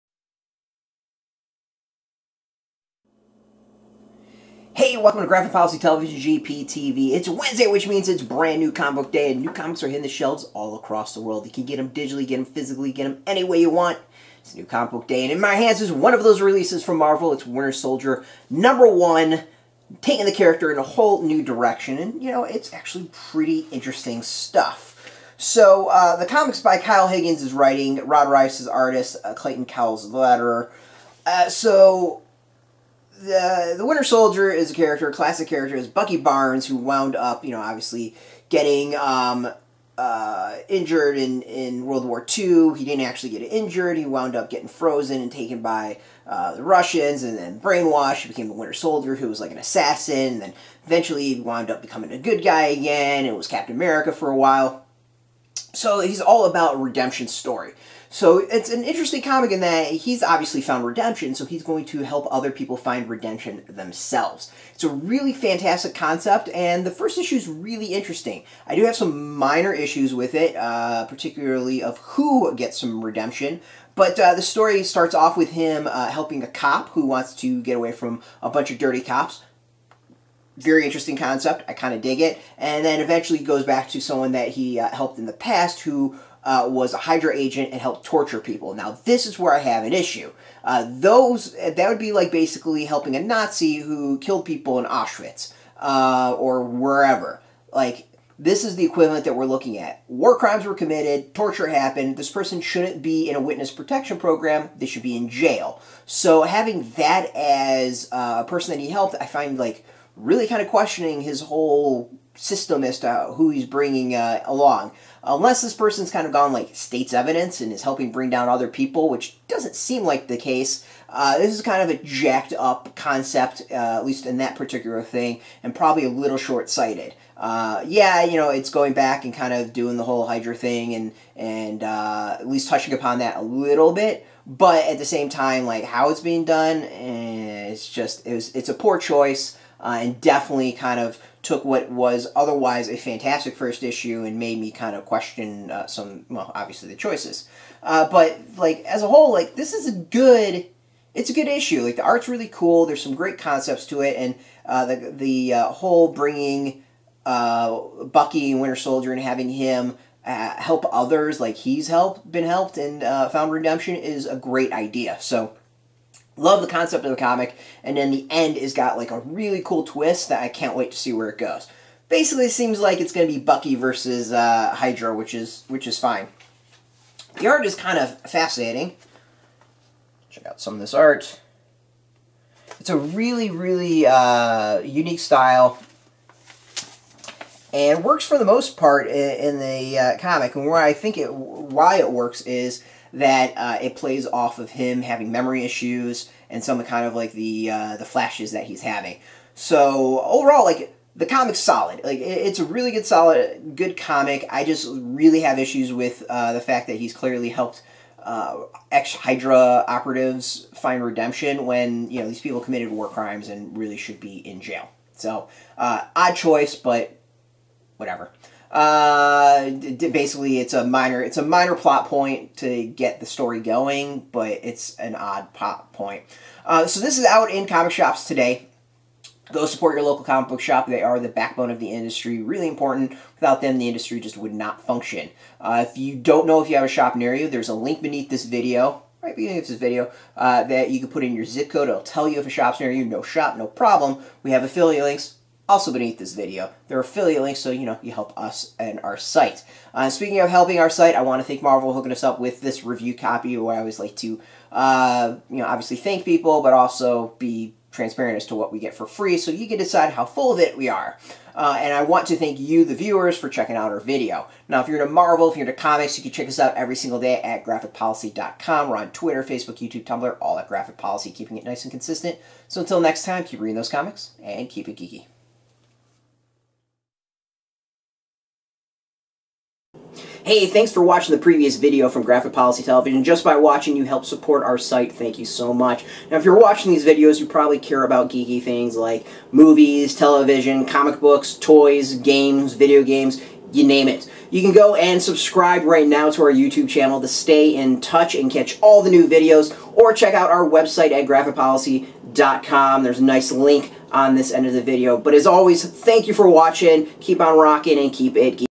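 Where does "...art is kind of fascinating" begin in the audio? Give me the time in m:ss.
2:57.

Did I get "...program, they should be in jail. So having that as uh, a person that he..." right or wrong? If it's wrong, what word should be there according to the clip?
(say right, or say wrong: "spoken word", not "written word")
right.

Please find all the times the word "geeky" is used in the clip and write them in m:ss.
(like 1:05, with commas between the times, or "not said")
4:34, 4:48, 5:08.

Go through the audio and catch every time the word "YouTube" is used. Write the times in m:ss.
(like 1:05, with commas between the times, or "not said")
4:29, 4:56.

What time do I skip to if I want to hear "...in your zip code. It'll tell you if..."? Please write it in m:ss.
4:01.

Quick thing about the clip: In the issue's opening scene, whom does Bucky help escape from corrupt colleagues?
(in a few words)
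A cop.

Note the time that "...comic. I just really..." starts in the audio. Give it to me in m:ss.
3:23.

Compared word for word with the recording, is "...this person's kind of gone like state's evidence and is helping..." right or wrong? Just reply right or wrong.
right.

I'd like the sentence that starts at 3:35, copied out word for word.
So uh, odd choice, but whatever.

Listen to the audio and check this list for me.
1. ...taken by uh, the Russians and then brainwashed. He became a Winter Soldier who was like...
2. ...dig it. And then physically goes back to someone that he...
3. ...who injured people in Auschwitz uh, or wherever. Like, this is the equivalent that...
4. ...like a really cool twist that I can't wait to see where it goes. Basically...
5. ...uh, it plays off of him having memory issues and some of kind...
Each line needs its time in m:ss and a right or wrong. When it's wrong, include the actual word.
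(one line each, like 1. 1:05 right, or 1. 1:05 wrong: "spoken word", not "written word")
1. 0:45 right
2. 1:22 wrong: "eventually", not "physically"
3. 1:33 wrong: "killed", not "injured"
4. 2:48 right
5. 3:13 right.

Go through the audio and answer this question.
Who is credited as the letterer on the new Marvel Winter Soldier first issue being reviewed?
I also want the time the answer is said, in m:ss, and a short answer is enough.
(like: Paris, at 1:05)
Clayton Cowles, at 0:29.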